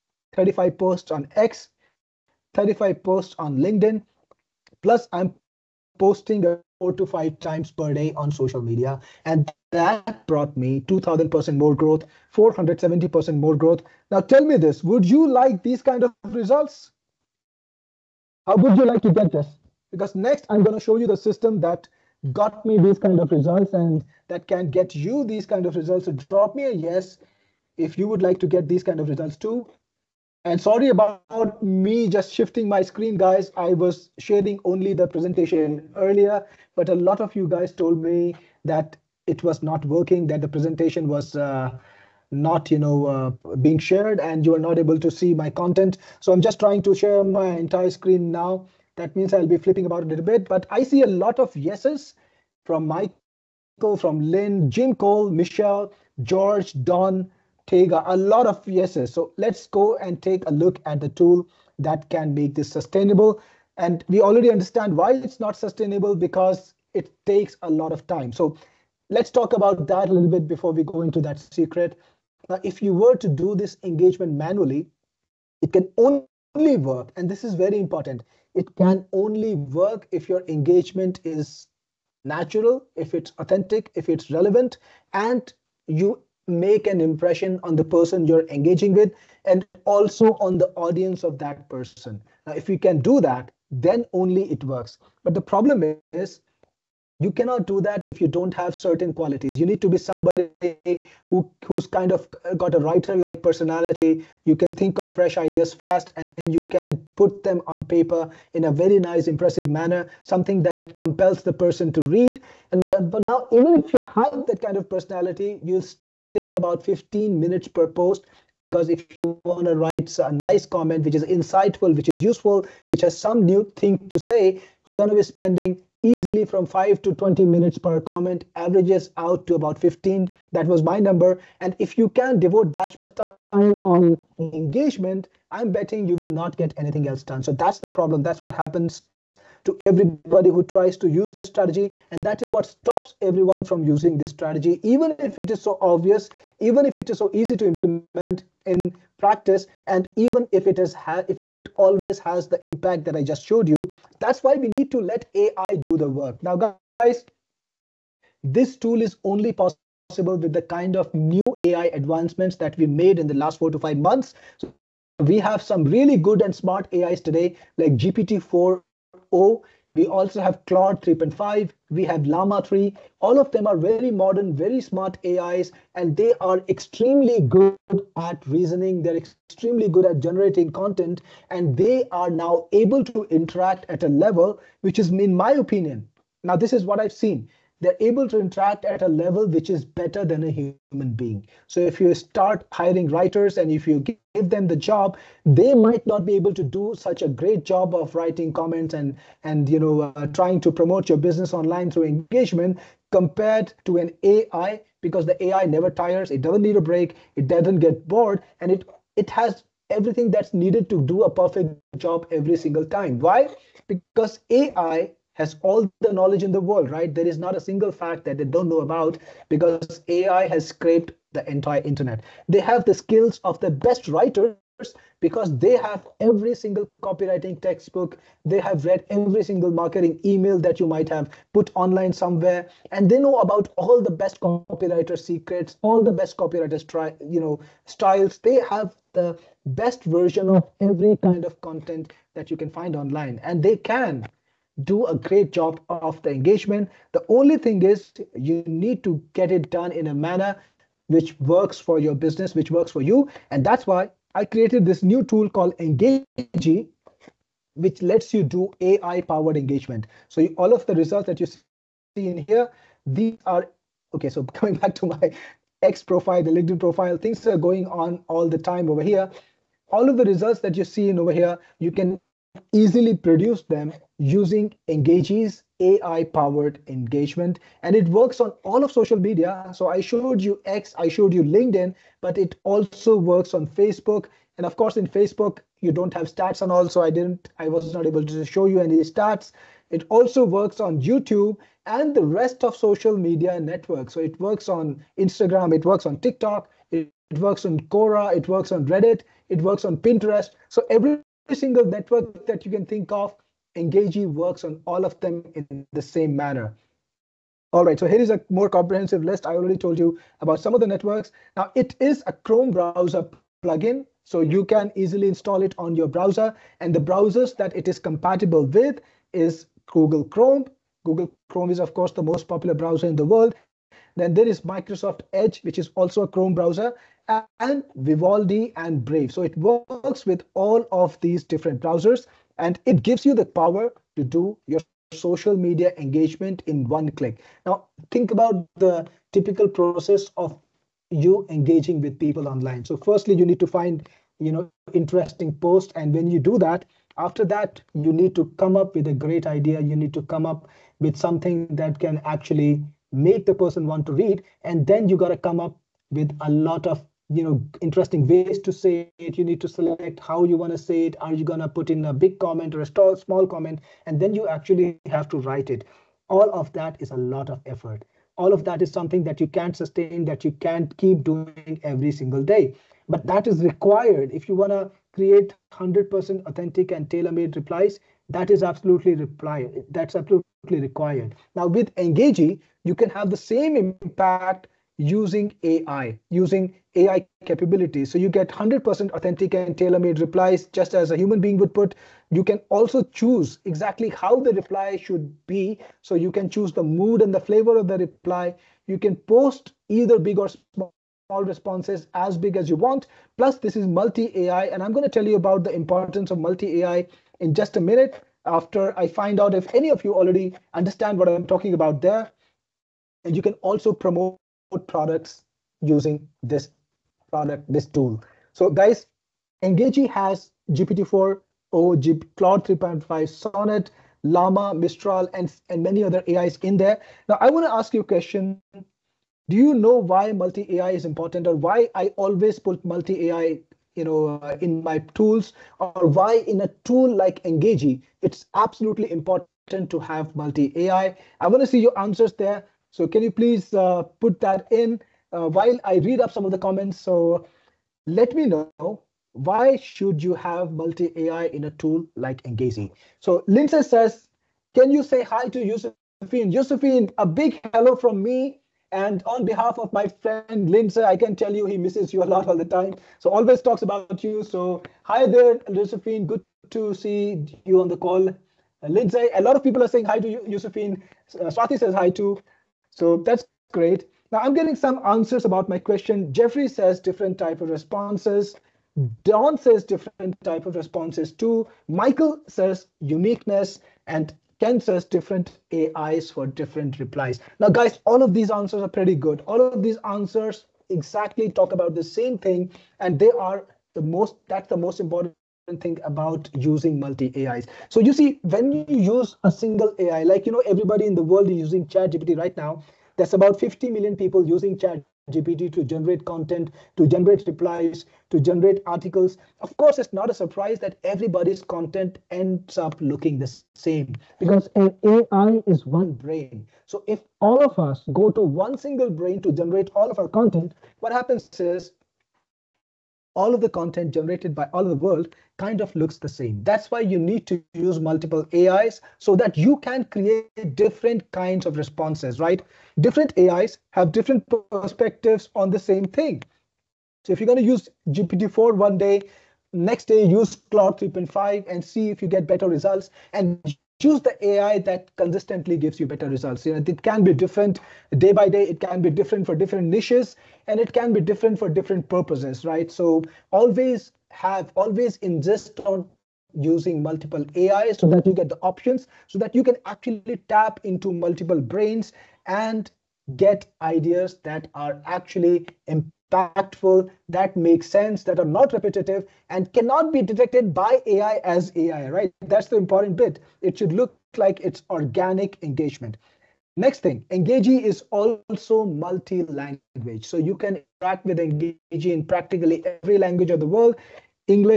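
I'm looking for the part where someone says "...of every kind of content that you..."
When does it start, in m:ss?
4:00.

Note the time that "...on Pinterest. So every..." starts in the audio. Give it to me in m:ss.
4:59.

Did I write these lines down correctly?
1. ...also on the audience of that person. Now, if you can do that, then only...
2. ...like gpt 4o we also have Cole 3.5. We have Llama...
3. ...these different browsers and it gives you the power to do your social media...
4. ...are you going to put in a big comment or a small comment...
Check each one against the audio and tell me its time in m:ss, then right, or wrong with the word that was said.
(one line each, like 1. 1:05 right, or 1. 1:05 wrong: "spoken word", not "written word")
1. 1:29 right
2. 2:47 wrong: "Claude", not "Cole"
3. 5:31 right
4. 6:01 right.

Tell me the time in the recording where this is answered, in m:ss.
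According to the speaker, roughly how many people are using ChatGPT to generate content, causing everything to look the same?
8:23.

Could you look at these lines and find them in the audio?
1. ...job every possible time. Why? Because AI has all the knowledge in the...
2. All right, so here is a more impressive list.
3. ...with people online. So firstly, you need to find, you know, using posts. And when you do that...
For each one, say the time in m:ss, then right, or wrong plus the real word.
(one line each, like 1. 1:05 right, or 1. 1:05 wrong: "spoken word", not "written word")
1. 3:31 wrong: "single", not "possible"
2. 5:07 wrong: "comprehensive", not "impressive"
3. 5:41 wrong: "interesting", not "using".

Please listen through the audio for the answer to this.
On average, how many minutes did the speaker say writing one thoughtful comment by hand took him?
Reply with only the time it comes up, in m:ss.
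2:08.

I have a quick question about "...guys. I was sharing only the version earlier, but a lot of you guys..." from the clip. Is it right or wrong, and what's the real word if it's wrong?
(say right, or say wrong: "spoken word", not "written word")
wrong: "presentation", not "version".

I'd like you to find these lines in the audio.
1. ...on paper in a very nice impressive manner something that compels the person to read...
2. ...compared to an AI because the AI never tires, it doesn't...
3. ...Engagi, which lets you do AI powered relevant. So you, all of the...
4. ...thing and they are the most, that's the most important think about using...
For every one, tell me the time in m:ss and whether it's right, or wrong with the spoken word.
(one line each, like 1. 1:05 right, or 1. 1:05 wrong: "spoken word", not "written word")
1. 1:47 right
2. 3:23 right
3. 4:15 wrong: "engagement", not "relevant"
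4. 8:12 right.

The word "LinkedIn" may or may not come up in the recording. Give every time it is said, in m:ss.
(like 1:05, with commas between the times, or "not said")
0:03, 4:26, 4:41.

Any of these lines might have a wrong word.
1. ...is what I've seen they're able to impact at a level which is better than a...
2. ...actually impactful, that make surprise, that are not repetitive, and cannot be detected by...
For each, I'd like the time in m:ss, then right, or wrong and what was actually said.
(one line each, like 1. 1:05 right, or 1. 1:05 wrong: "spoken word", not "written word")
1. 3:06 wrong: "interact", not "impact"
2. 9:25 wrong: "sense", not "surprise".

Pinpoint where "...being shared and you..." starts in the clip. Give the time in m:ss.
0:43.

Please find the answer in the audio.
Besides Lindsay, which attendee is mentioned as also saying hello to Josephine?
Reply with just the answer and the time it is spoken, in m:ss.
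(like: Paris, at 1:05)
Swati, at 7:51.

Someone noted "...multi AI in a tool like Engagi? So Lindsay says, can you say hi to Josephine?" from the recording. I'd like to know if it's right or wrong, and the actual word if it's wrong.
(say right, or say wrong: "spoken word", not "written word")
right.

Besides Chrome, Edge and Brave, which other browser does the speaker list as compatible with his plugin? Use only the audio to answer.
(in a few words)
Vivaldi.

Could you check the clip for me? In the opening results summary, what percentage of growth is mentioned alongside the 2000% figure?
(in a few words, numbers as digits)
470%.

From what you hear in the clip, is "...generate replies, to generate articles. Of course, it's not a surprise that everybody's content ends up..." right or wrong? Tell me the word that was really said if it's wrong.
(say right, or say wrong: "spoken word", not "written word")
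right.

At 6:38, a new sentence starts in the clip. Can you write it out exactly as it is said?
You can post either big or small responses as big as you want.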